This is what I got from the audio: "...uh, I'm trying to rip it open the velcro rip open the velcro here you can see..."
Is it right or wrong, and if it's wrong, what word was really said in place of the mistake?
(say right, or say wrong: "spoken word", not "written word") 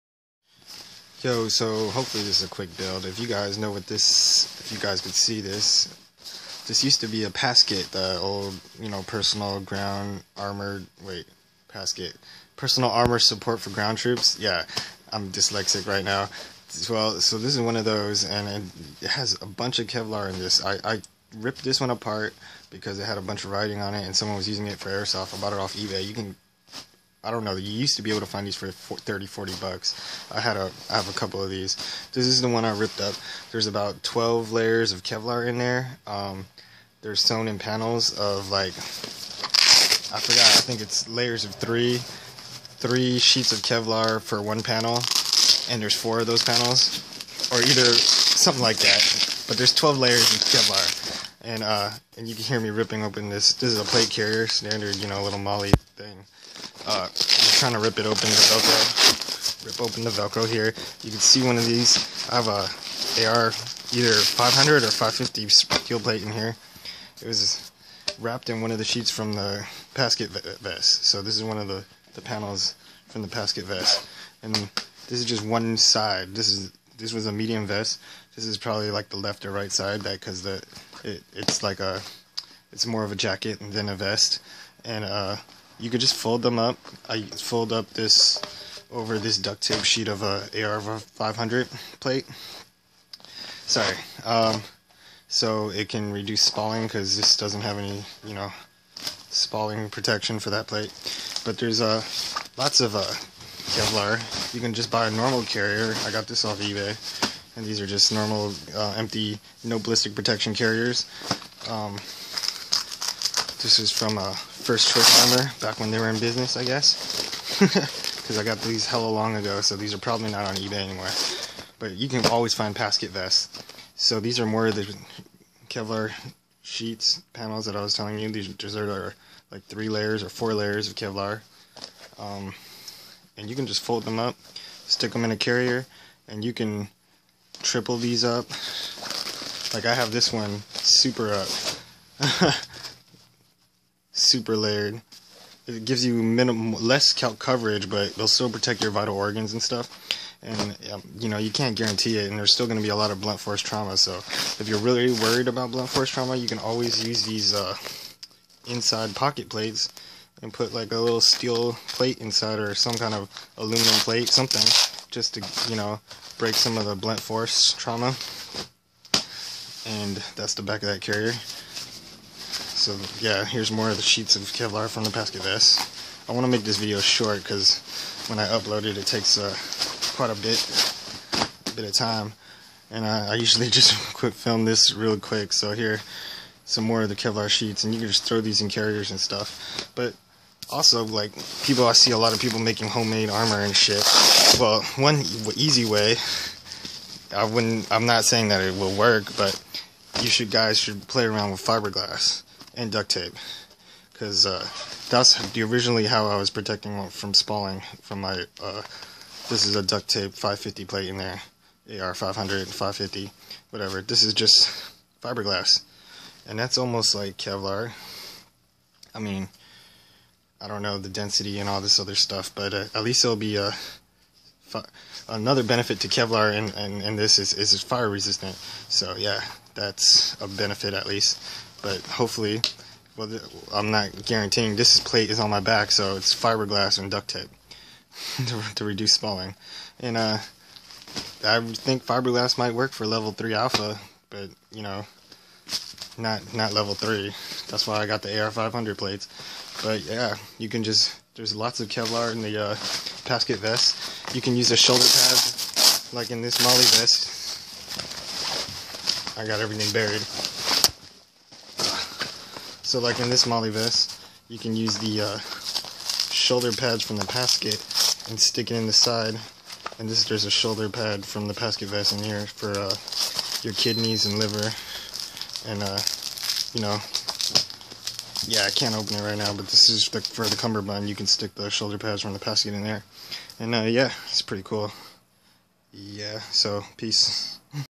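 right.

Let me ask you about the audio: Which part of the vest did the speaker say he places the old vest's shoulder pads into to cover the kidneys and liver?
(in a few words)
Cummerbund.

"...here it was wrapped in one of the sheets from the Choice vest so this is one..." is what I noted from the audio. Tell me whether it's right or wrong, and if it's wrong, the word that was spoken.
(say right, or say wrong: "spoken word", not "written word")
wrong: "PASGT", not "Choice".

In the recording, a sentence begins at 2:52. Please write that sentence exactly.
So yeah, here's more of the sheets of Kevlar from the PASGT vest.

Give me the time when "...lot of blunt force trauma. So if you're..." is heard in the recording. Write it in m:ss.
2:32.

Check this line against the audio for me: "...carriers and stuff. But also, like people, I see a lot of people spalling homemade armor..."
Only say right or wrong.
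wrong.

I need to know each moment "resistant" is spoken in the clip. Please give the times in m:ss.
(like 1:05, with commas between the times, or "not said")
3:48.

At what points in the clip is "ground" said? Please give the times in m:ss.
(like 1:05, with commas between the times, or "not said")
0:09, 0:13.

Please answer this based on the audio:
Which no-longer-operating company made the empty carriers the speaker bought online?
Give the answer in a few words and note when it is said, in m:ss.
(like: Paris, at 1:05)
First Choice Armor, at 1:54.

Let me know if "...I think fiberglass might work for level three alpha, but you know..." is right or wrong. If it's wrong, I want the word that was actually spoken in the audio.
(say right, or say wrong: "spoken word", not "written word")
right.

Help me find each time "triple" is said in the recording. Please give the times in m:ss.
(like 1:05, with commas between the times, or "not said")
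2:17.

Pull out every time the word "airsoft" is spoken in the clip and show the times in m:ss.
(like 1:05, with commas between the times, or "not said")
0:24.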